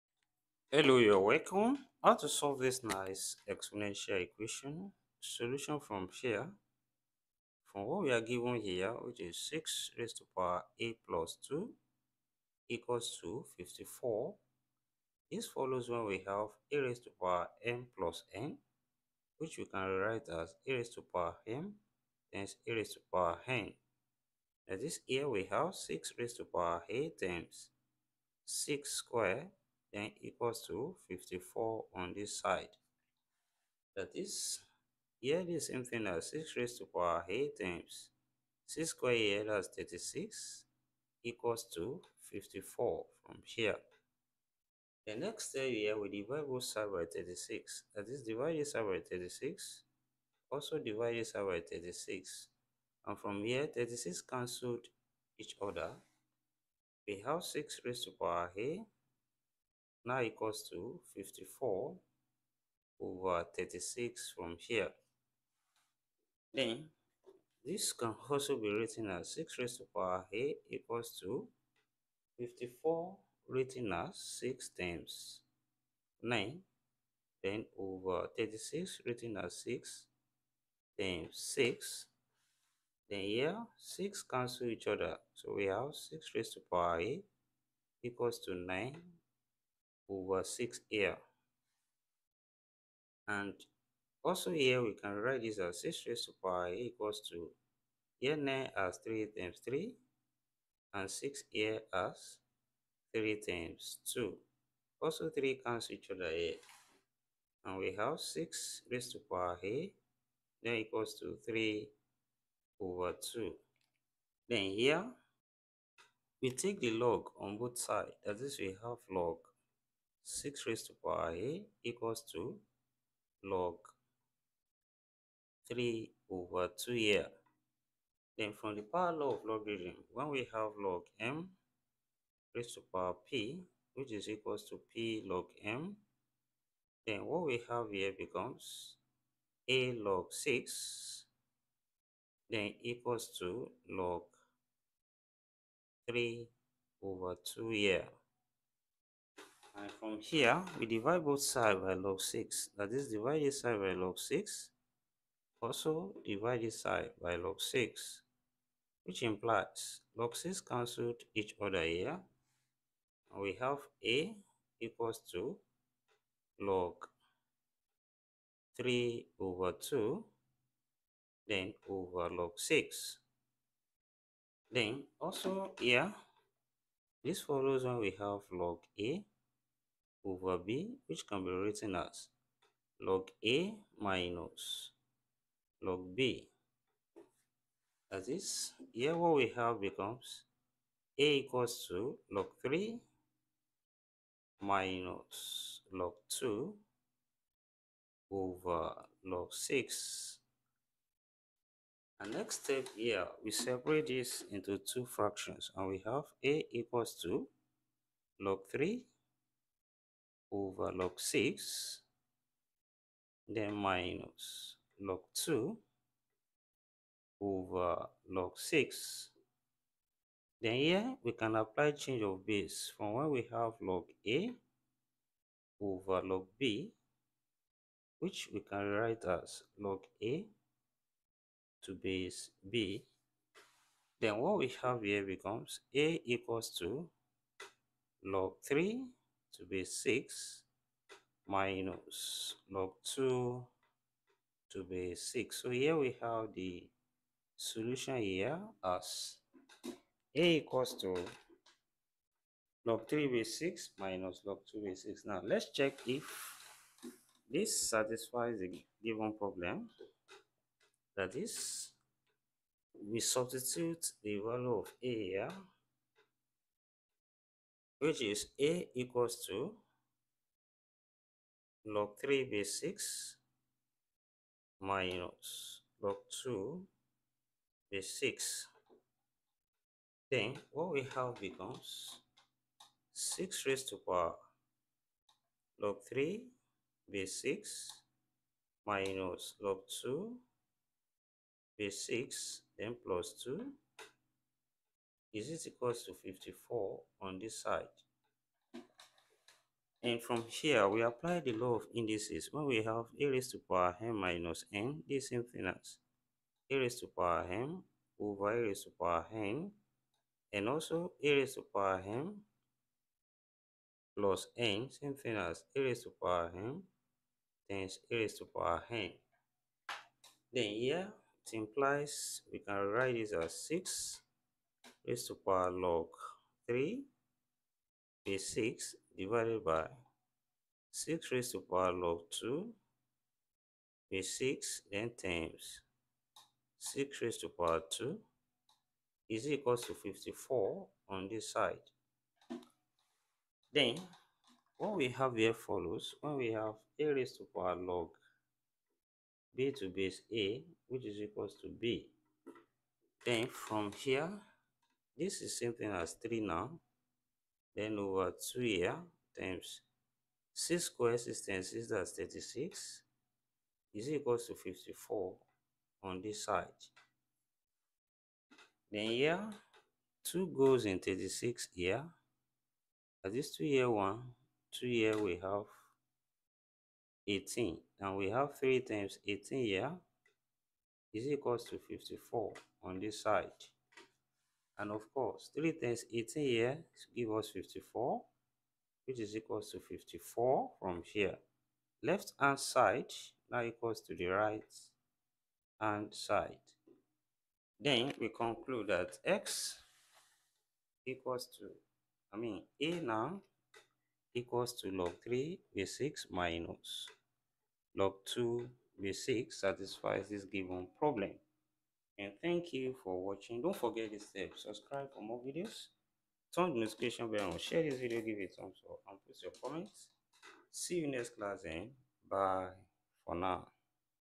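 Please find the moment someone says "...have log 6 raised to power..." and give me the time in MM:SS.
01:58.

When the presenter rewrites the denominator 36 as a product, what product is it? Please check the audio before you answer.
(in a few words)
6 times 6.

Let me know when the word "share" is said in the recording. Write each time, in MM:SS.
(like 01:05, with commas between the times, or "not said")
06:57.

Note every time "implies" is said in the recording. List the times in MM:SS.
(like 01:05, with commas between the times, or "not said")
02:39, 05:21.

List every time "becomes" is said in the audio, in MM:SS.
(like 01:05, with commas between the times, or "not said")
02:18, 03:09, 03:55, 04:41.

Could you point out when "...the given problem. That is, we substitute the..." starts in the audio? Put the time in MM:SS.
04:18.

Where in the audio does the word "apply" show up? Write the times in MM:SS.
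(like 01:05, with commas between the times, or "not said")
03:41, 05:01.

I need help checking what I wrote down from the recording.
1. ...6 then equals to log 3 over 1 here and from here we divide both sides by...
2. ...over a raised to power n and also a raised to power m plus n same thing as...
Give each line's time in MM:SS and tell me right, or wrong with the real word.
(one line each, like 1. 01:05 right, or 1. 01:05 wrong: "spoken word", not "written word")
1. 02:20 wrong: "2", not "1"
2. 05:08 right.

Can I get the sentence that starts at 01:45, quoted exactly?
Also 3 cancels each other here.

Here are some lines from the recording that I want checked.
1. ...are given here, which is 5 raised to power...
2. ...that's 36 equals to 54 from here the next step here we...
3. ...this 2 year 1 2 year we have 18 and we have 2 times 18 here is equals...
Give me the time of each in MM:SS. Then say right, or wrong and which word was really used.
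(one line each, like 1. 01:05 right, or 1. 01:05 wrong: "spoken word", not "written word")
1. 00:08 wrong: "6", not "5"
2. 00:39 right
3. 06:13 wrong: "3", not "2".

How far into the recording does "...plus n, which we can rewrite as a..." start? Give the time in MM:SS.
00:17.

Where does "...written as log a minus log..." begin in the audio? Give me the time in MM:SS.
03:01.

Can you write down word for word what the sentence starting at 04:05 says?
So here we have the solution here as a equals to log 3 base 6 minus log 2 base 6.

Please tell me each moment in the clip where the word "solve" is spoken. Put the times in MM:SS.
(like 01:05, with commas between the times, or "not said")
00:02.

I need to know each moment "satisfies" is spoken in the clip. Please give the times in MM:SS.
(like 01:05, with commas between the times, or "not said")
04:17, 06:49.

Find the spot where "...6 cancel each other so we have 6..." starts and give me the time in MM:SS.
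01:23.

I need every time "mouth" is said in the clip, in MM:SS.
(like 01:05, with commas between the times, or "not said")
not said.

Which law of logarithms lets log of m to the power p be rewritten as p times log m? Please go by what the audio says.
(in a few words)
power law.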